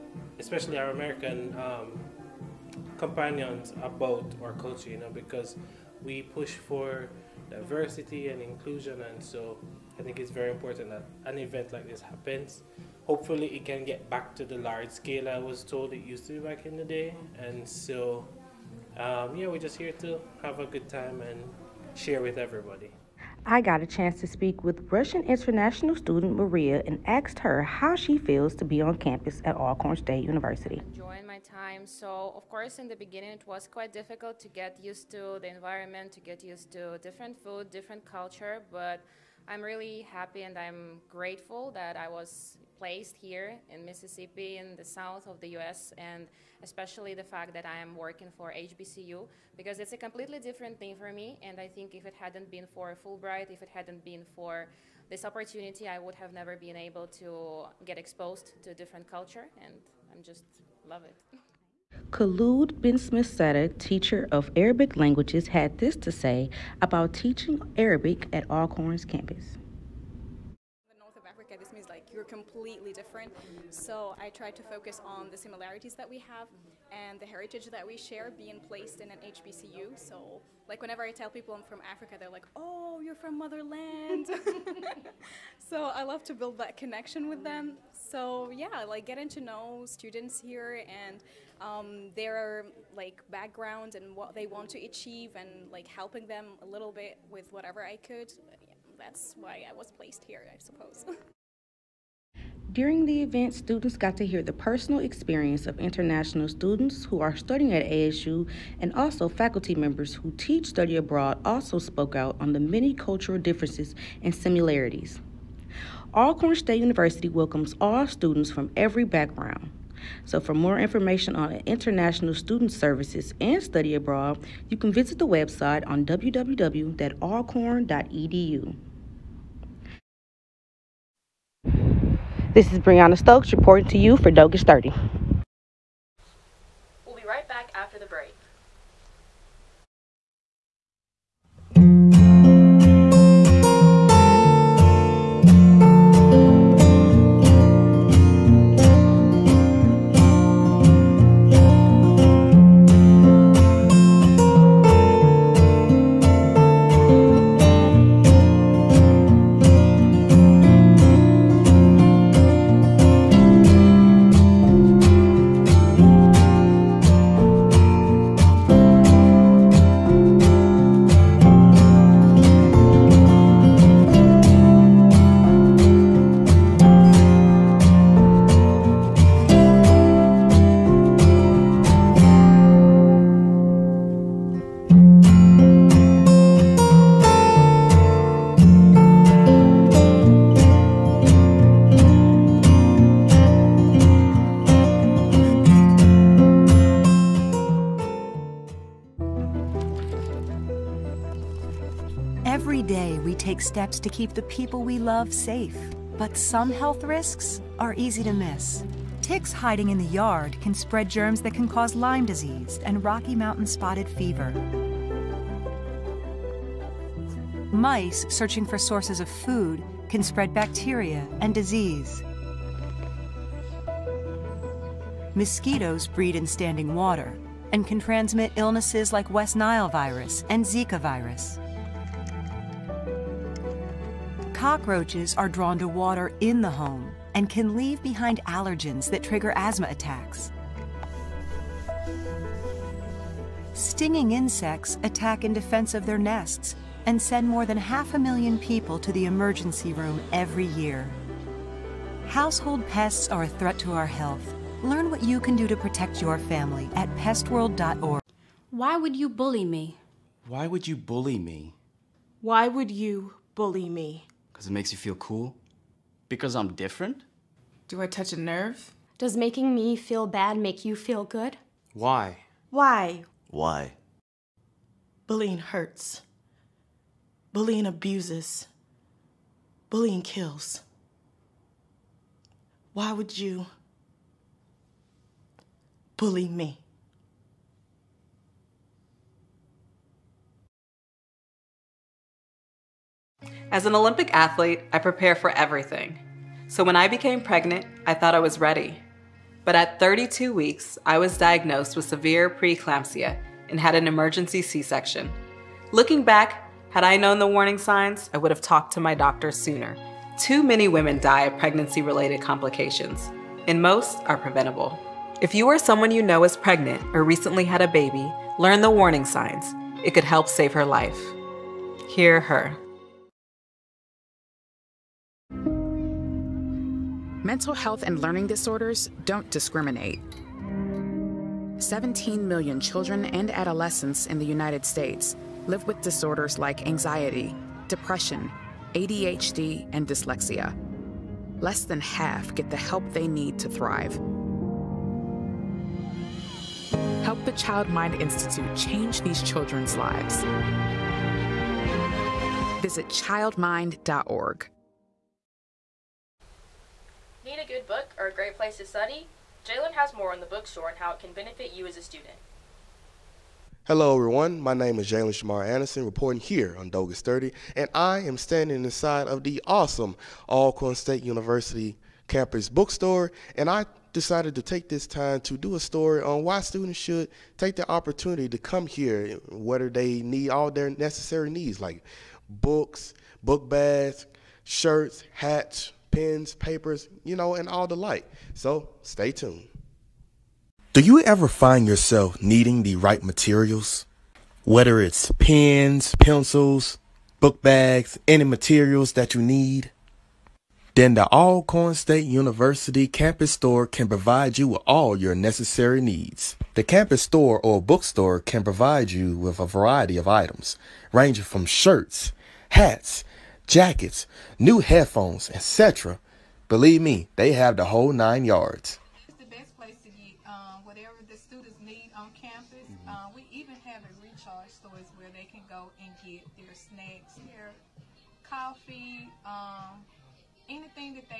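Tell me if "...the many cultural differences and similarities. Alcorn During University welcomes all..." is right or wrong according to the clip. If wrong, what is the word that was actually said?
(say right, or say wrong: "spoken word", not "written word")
wrong: "State", not "During".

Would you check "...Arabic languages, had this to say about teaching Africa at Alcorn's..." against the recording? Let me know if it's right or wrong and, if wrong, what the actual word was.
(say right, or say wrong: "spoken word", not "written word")
wrong: "Arabic", not "Africa".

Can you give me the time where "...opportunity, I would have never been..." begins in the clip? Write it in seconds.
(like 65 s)
55 s.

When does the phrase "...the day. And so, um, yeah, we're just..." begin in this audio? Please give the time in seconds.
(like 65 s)
16 s.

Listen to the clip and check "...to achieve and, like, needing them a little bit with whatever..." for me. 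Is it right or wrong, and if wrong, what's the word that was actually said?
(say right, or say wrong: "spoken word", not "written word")
wrong: "helping", not "needing".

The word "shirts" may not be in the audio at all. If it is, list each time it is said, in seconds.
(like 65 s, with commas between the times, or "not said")
384 s, 411 s.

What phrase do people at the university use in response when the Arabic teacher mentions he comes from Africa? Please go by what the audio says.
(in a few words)
motherland.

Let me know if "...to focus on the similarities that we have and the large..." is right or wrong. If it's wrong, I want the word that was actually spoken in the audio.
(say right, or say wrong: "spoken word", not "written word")
wrong: "heritage", not "large".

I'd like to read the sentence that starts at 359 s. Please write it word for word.
Jalen has more on the bookstore and how it can benefit you as a student.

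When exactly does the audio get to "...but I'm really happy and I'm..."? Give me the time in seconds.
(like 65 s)
38 s.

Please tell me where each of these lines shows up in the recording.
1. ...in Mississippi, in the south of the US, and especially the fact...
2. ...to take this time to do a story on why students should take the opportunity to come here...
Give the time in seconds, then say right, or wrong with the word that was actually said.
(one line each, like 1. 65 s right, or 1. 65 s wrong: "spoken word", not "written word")
1. 43 s right
2. 374 s right.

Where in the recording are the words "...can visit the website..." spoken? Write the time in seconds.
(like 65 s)
124 s.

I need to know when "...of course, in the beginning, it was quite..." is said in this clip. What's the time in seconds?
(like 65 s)
32 s.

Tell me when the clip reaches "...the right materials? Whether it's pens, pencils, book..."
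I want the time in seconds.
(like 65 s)
392 s.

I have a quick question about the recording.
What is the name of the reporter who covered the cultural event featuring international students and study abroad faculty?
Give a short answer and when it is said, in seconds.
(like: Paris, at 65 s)
Brianna Stokes, at 132 s.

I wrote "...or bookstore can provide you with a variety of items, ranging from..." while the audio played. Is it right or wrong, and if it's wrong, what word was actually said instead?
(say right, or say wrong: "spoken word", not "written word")
right.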